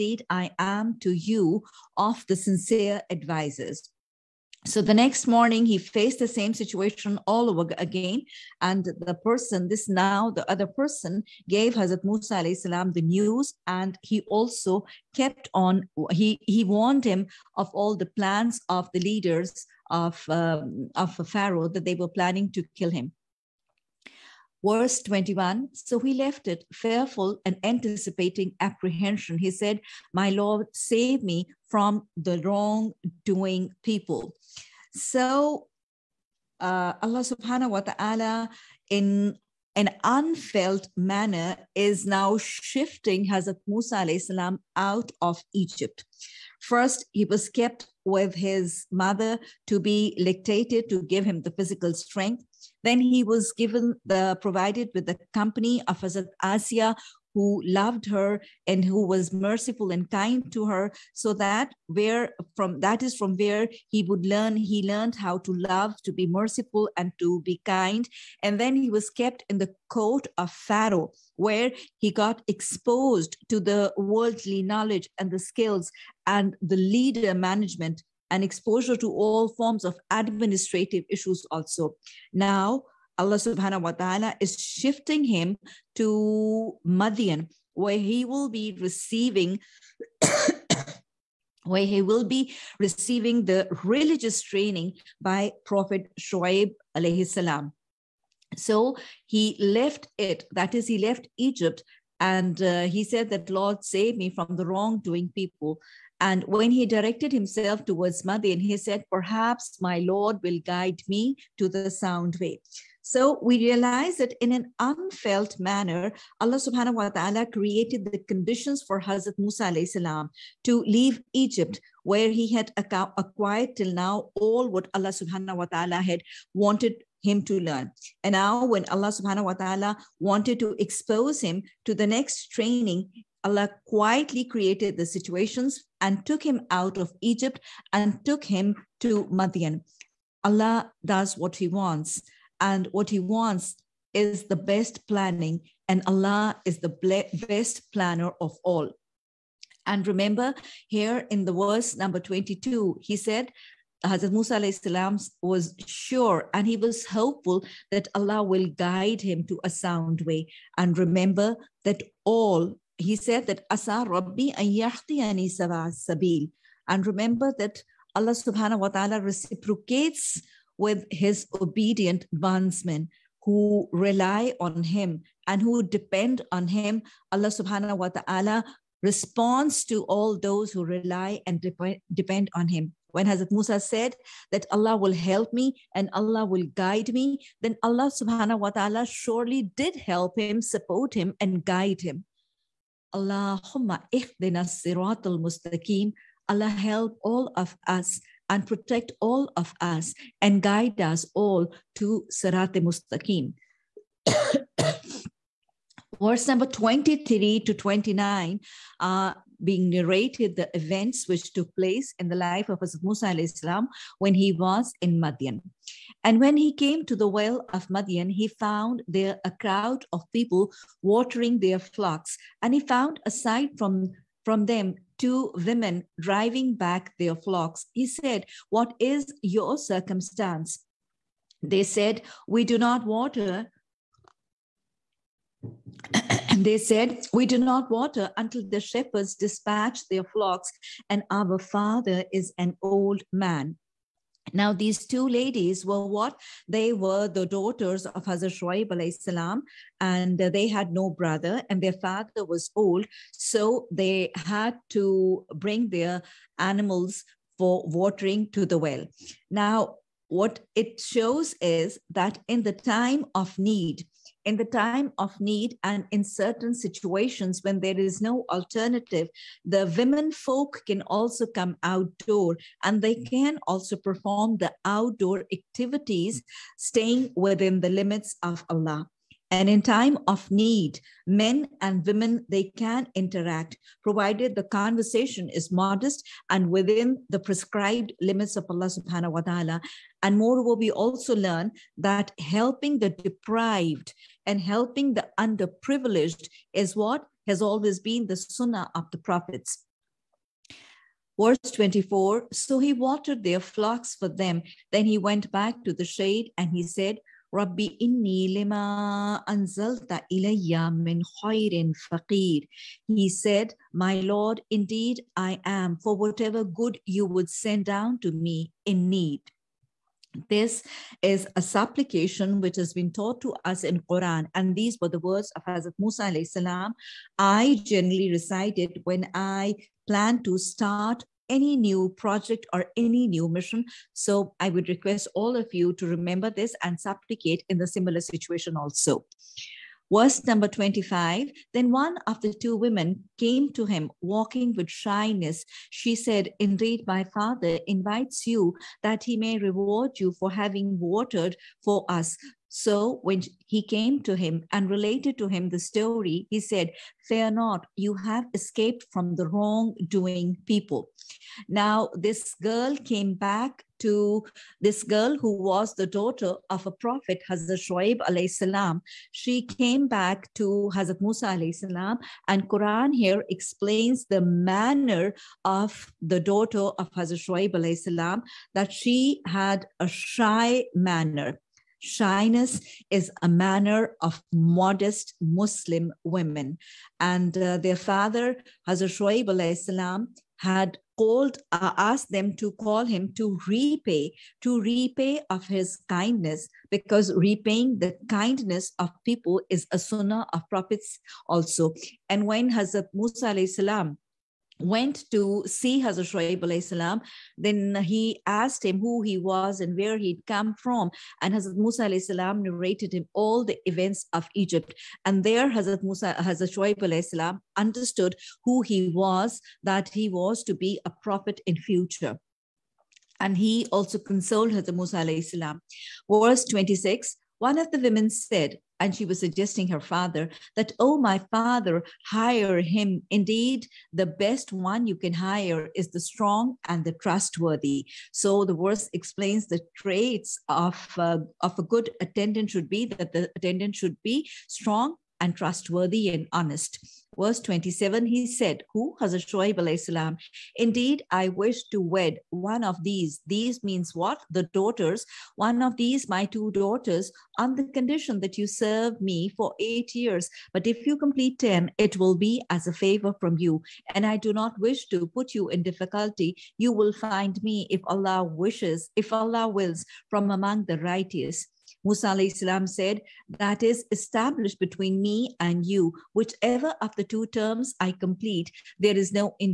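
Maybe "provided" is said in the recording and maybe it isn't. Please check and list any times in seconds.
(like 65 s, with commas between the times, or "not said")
54 s, 284 s.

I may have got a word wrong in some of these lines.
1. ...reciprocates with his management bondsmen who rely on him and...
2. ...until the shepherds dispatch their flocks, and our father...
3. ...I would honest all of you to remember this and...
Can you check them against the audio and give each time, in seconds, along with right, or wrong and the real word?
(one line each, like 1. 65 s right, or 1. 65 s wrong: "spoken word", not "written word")
1. 169 s wrong: "obedient", not "management"
2. 238 s right
3. 334 s wrong: "request", not "honest".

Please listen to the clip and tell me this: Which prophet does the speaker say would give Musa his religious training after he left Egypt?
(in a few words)
Prophet Shoaib.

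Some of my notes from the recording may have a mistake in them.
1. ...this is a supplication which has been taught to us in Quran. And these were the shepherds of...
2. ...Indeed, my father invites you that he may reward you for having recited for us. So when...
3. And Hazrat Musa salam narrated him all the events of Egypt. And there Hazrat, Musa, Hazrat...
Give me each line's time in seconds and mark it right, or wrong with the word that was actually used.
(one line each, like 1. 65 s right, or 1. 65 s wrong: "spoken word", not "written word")
1. 320 s wrong: "words", not "shepherds"
2. 346 s wrong: "watered", not "recited"
3. 411 s right.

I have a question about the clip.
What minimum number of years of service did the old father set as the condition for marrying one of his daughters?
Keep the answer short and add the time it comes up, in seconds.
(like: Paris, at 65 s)
8, at 459 s.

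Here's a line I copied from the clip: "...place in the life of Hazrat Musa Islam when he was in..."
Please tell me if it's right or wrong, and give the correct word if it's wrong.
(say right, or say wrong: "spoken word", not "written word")
right.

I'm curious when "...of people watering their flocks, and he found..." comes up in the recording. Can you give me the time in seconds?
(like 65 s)
220 s.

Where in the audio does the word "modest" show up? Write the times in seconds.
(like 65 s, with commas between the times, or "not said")
285 s, 384 s.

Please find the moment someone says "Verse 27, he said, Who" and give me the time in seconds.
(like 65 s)
447 s.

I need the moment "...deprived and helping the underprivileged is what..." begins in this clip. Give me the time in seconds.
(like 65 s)
293 s.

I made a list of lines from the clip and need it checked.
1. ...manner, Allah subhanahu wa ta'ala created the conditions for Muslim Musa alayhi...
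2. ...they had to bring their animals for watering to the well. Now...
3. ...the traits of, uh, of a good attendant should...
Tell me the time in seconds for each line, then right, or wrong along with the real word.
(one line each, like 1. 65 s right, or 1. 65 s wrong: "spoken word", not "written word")
1. 115 s wrong: "Hazrat", not "Muslim"
2. 253 s right
3. 439 s right.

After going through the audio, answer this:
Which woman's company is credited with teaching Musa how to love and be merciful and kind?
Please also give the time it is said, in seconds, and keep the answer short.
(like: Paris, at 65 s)
Hazrat Asiya, at 56 s.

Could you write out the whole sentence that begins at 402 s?
And when Hazrat Musa salam went to see Hazrat Shoaib salam.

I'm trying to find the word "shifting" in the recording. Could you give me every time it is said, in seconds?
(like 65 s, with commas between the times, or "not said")
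42 s, 84 s.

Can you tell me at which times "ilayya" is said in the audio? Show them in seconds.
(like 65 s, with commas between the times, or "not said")
310 s.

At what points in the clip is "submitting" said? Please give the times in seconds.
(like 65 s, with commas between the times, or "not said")
not said.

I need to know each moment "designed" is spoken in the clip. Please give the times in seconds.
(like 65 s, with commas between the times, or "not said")
not said.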